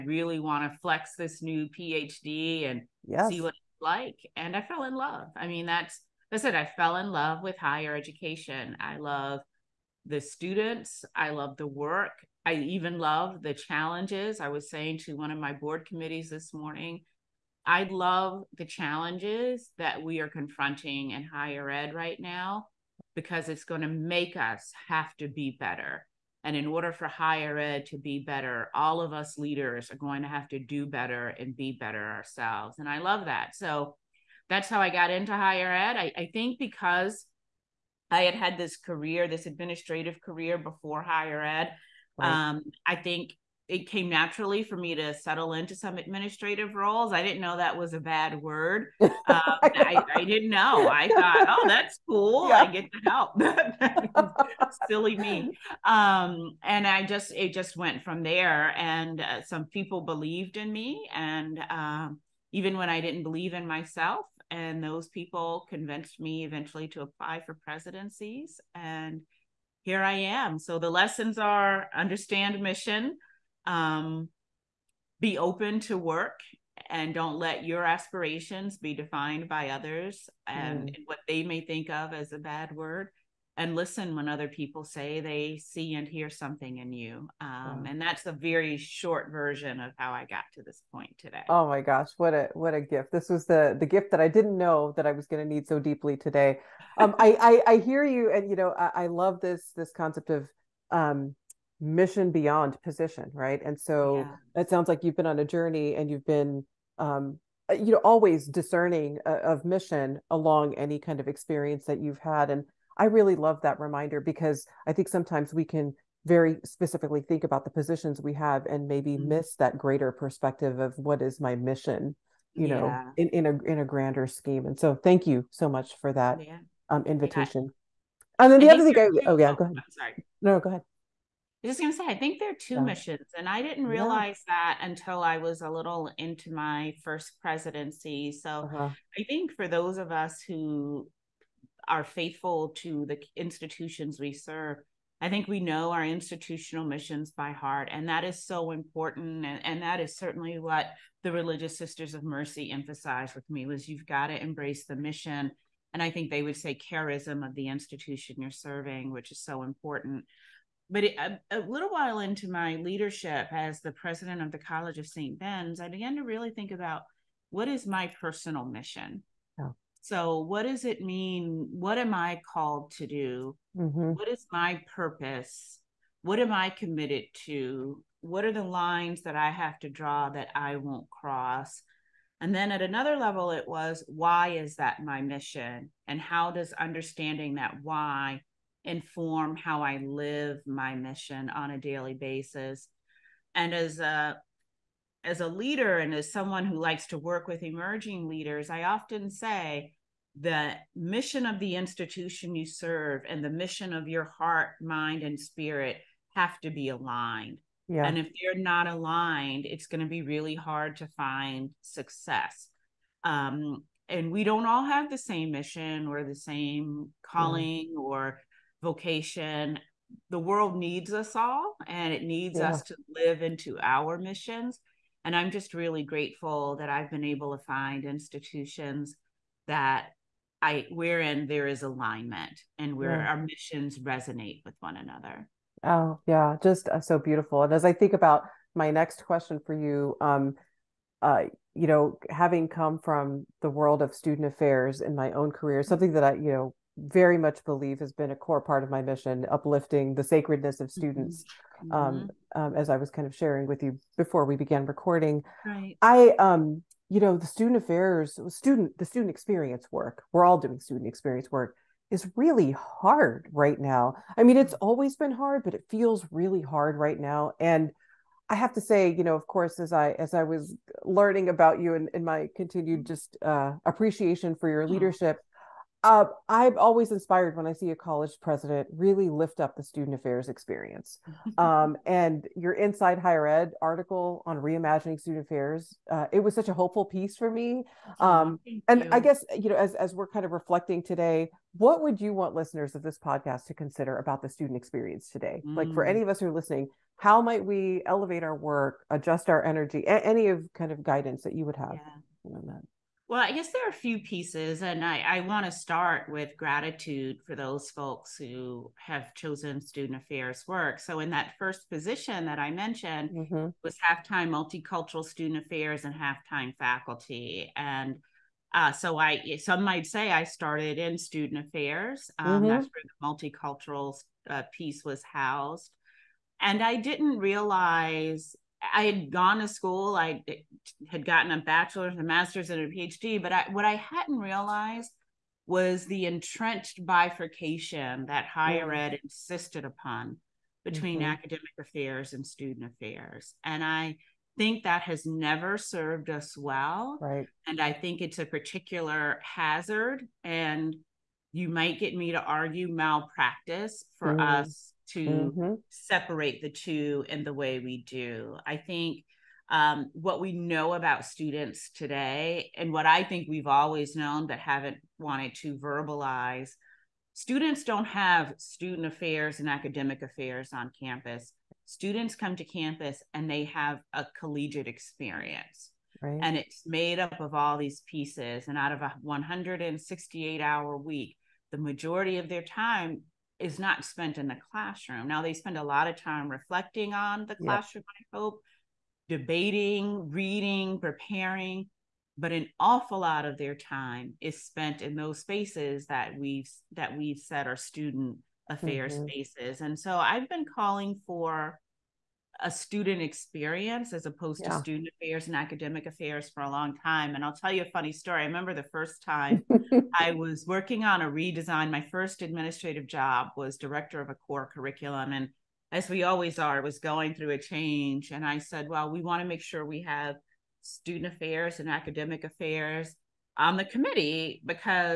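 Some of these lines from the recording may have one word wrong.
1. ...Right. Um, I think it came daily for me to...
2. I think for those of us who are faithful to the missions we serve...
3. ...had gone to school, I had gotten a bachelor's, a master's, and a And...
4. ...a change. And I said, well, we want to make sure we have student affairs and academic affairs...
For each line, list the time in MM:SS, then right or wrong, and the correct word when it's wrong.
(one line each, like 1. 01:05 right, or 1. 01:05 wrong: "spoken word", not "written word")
1. 00:42 wrong: "naturally", not "daily"
2. 02:19 wrong: "institutions", not "missions"
3. 05:29 wrong: "PhD", not "And"
4. 06:57 right.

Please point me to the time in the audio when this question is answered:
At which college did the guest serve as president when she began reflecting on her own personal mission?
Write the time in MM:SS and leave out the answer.
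02:44.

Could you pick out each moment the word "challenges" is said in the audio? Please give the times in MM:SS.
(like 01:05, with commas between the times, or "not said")
00:13, 00:18.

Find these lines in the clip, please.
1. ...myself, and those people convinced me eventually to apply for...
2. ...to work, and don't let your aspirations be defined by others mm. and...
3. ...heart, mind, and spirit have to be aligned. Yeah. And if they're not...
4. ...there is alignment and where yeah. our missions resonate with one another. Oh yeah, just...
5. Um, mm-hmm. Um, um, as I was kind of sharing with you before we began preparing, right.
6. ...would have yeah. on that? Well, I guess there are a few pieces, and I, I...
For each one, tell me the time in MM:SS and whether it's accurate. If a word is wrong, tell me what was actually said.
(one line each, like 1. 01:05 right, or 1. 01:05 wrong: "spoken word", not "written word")
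1. 01:03 right
2. 01:15 right
3. 03:24 right
4. 03:51 right
5. 04:11 wrong: "recording", not "preparing"
6. 05:01 right.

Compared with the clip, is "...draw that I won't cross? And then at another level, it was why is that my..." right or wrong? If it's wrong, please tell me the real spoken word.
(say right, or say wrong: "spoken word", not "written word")
right.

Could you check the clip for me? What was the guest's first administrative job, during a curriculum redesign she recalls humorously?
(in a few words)
director of a core curriculum.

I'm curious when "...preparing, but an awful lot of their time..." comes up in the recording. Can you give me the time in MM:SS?
06:30.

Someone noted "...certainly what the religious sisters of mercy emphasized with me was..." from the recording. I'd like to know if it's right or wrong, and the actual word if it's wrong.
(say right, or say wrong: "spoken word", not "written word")
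right.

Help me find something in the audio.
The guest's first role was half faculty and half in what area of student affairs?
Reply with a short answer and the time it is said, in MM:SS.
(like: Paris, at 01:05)
multicultural student affairs, at 05:14.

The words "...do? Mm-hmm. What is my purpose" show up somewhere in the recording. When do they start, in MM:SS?
02:53.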